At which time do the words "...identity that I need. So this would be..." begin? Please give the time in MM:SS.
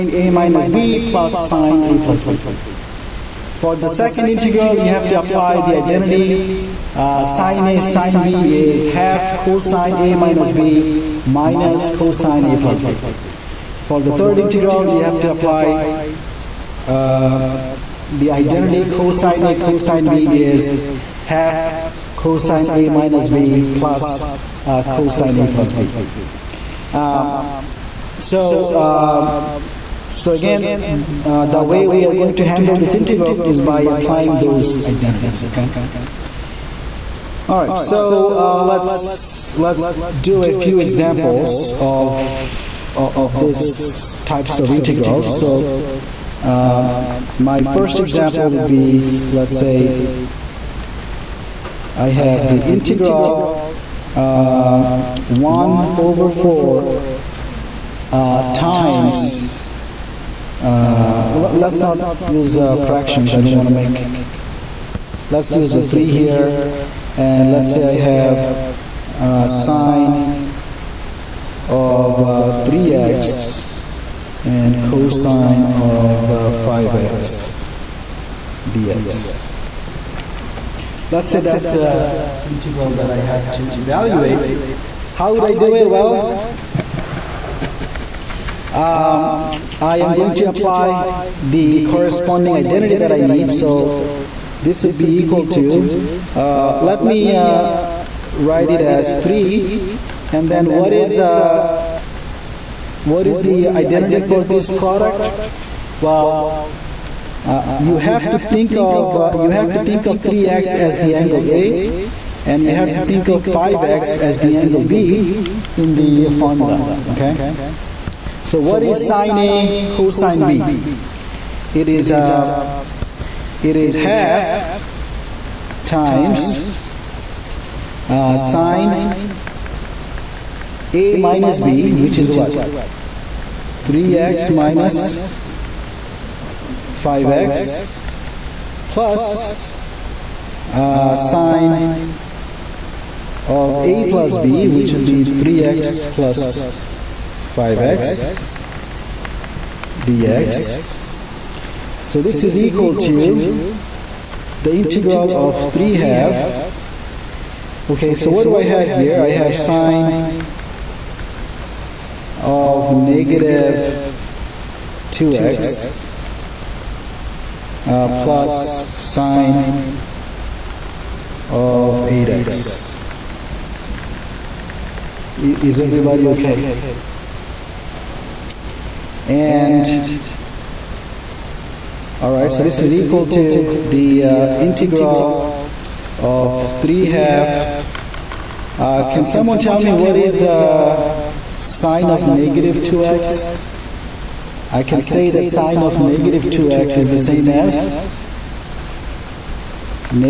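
01:32.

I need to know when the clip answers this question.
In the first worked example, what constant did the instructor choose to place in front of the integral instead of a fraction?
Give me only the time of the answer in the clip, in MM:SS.
01:05.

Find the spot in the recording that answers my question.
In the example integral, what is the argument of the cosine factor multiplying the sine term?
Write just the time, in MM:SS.
01:14.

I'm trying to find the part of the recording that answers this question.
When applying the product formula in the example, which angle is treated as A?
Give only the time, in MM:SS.
01:50.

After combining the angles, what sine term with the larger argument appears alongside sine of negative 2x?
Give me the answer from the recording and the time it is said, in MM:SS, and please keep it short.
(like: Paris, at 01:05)
sine of 8x, at 02:48.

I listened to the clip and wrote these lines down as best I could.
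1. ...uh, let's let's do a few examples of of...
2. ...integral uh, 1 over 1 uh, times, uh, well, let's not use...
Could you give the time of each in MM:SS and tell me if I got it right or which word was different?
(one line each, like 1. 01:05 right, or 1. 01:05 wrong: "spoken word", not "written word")
1. 00:38 right
2. 00:52 wrong: "4", not "1".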